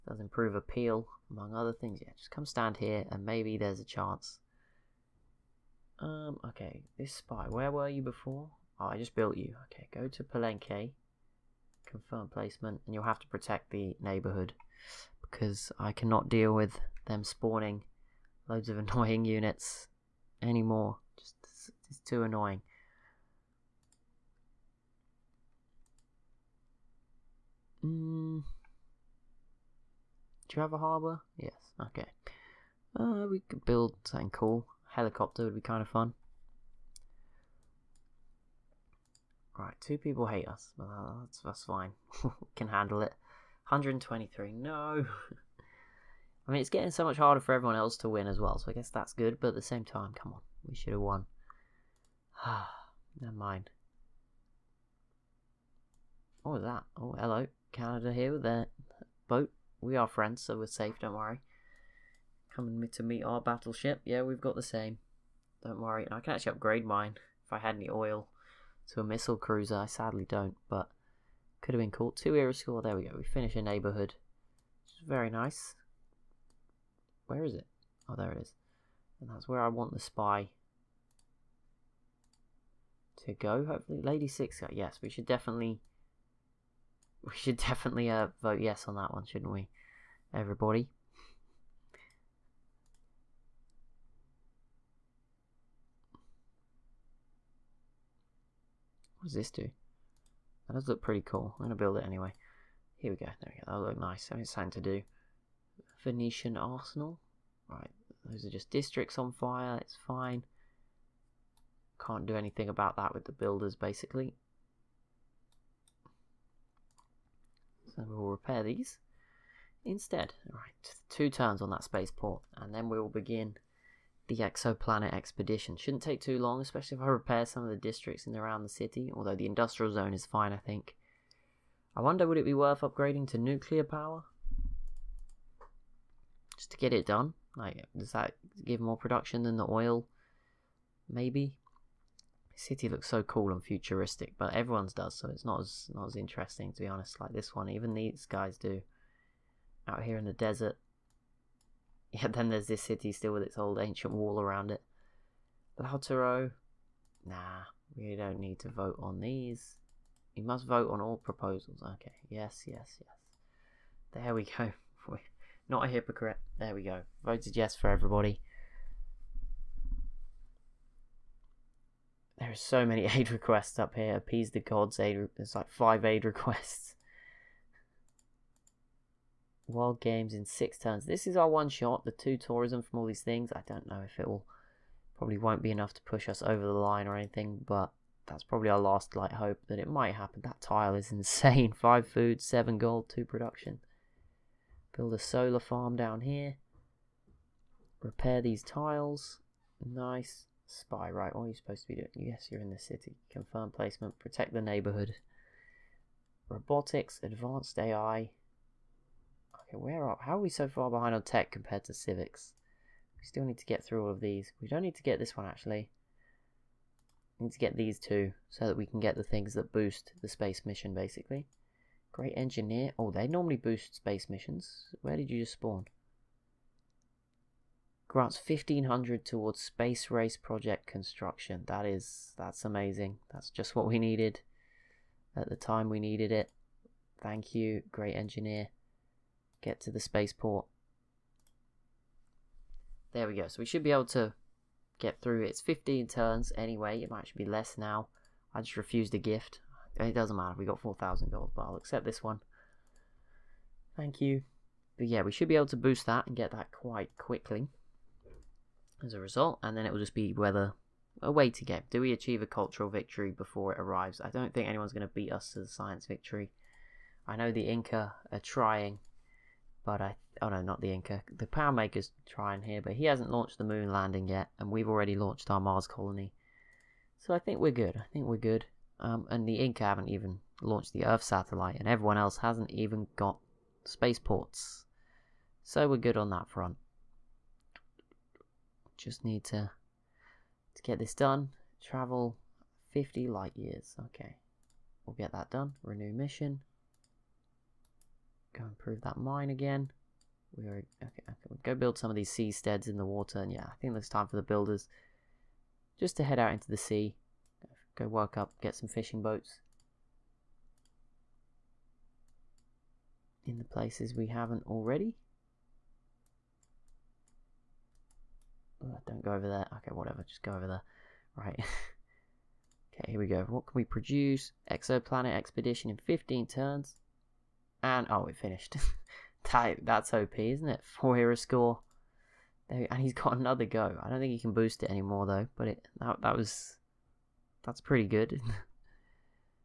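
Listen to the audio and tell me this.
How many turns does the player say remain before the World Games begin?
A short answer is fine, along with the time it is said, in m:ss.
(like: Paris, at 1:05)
6, at 3:00.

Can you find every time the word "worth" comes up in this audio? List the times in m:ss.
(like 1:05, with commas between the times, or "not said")
2:12.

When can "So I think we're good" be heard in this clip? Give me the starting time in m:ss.
4:37.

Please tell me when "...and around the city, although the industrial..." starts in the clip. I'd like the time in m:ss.
2:08.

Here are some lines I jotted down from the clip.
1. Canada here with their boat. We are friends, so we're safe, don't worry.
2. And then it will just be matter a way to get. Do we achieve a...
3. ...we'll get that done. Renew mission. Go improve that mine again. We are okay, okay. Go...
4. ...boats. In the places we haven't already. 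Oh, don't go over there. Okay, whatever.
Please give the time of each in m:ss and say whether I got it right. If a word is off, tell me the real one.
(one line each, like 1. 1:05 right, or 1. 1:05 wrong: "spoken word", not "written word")
1. 0:57 right
2. 4:19 wrong: "whether", not "matter"
3. 4:55 right
4. 5:09 right.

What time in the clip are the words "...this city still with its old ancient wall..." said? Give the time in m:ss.
2:32.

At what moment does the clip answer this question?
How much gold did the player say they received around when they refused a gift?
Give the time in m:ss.
4:10.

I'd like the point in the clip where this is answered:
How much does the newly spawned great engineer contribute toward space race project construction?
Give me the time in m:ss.
3:48.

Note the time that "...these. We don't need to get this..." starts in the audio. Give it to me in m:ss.
3:34.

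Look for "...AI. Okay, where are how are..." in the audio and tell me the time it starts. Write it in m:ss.
3:27.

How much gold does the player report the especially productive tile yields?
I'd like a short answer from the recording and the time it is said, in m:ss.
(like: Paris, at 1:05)
7 gold, at 3:12.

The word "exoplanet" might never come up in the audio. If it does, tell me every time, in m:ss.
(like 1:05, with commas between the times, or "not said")
2:04, 5:24.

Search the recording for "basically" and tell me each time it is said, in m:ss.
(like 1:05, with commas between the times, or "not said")
1:53, 3:40.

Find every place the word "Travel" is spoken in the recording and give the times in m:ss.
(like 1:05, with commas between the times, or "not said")
4:51.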